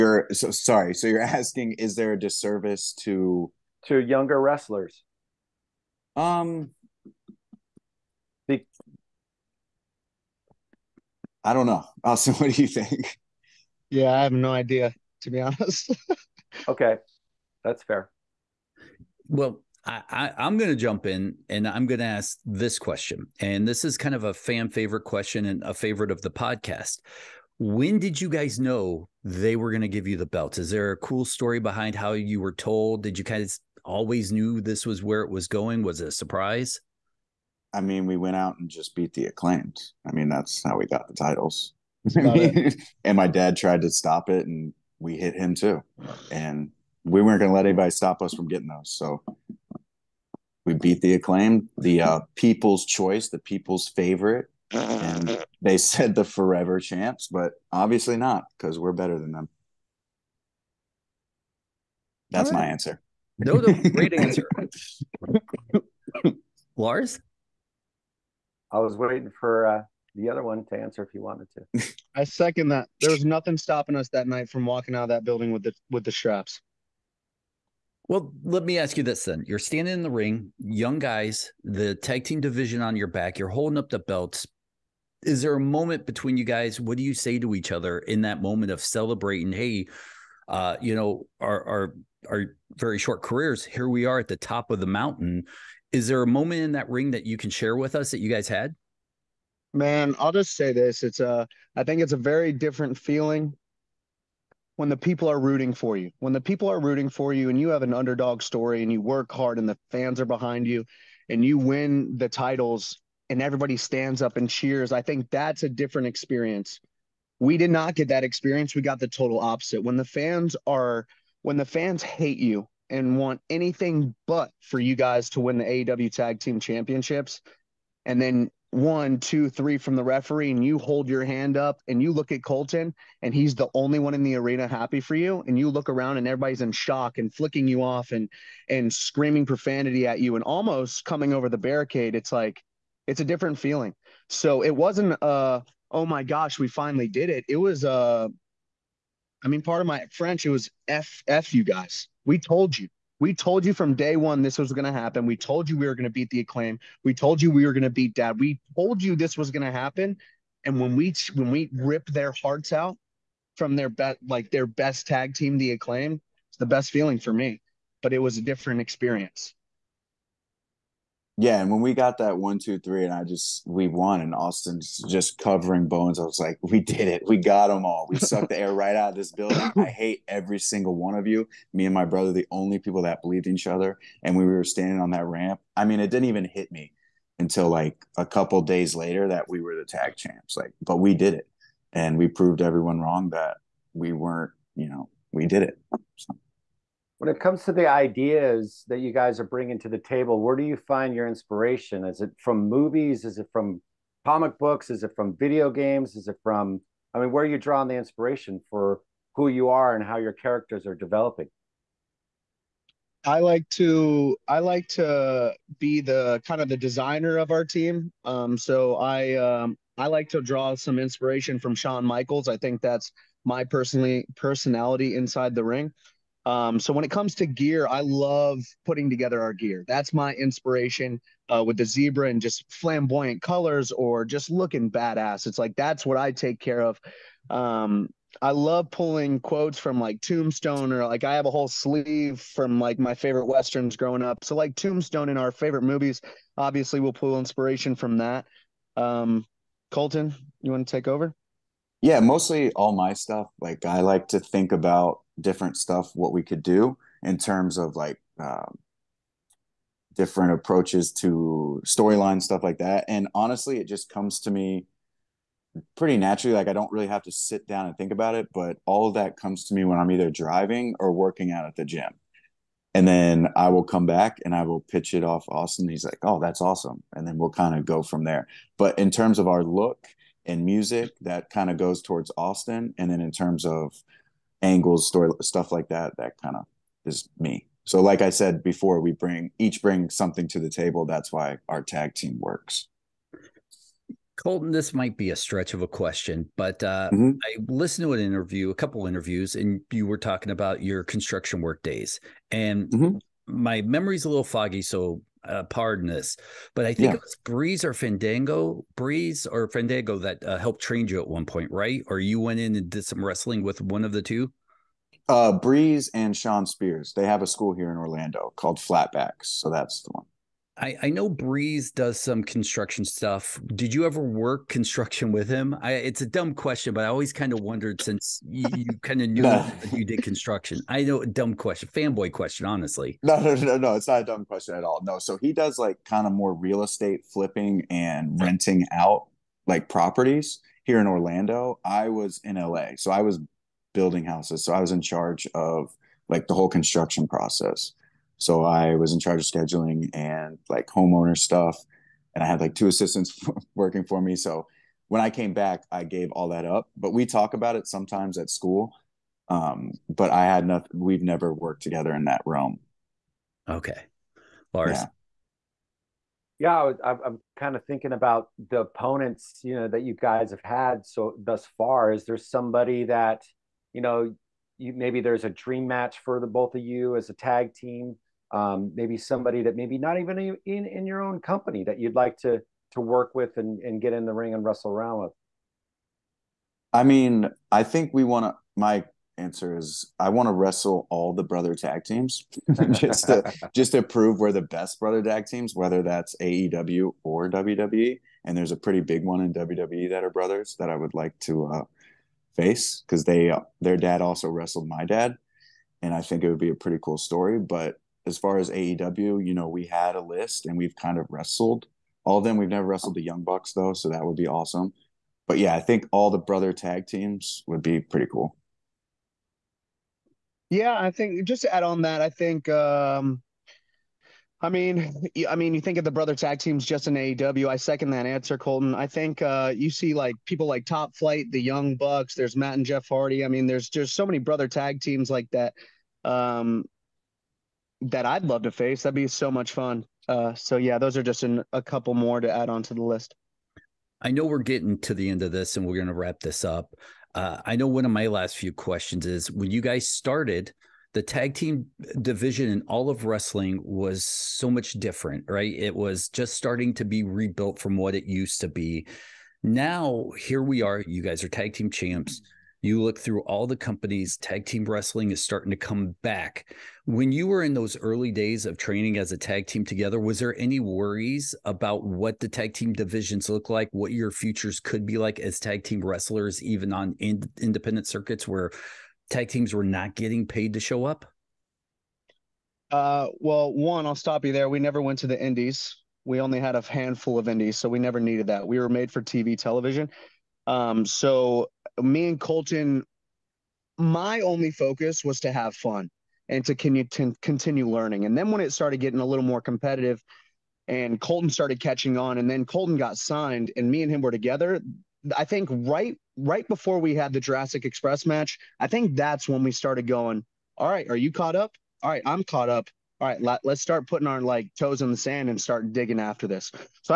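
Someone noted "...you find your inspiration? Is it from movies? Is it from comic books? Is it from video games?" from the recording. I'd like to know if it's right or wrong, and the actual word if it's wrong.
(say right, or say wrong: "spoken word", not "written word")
right.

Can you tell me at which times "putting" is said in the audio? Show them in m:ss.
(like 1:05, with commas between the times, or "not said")
3:48, 8:34.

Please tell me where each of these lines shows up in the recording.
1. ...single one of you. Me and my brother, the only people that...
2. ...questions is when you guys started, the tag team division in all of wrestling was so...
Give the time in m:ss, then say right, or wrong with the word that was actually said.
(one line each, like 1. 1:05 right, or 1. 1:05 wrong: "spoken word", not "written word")
1. 3:00 right
2. 7:28 right.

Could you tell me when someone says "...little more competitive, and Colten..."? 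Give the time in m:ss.
8:19.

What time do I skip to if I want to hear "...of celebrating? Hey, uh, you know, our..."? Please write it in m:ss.
1:28.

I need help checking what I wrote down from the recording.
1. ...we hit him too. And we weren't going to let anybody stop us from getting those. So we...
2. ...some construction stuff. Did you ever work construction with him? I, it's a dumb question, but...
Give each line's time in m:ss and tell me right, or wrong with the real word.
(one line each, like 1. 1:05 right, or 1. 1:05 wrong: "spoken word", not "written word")
1. 0:44 right
2. 5:22 right.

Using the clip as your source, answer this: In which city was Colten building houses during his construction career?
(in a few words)
LA.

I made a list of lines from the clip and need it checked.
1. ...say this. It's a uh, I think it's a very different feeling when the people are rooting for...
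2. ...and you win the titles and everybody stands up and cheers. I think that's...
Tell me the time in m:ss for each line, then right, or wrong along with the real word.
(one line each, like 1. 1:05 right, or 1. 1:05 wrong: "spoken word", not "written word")
1. 1:40 right
2. 1:51 right.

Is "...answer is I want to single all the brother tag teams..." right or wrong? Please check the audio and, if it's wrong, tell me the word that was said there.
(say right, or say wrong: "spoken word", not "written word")
wrong: "wrestle", not "single".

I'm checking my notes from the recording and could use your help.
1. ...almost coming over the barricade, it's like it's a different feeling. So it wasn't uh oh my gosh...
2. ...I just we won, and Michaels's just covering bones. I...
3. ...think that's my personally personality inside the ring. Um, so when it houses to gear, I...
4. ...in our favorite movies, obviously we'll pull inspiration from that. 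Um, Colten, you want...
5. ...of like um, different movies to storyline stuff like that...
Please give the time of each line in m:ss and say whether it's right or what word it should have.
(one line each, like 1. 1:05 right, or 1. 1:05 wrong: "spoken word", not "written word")
1. 2:20 right
2. 2:53 wrong: "Austin", not "Michaels"
3. 3:42 wrong: "comes", not "houses"
4. 4:05 right
5. 4:17 wrong: "approaches", not "movies".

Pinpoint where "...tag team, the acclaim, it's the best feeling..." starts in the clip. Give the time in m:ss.
2:45.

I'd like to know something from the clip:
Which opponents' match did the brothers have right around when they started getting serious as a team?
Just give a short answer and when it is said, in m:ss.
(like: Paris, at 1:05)
Jurassic Express, at 8:27.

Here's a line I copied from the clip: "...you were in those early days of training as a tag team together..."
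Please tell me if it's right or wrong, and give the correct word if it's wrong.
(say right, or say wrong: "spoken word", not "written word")
right.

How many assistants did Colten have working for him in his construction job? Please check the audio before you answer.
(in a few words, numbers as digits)
2.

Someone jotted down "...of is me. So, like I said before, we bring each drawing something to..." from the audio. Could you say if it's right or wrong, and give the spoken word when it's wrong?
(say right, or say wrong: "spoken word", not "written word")
wrong: "bring", not "drawing".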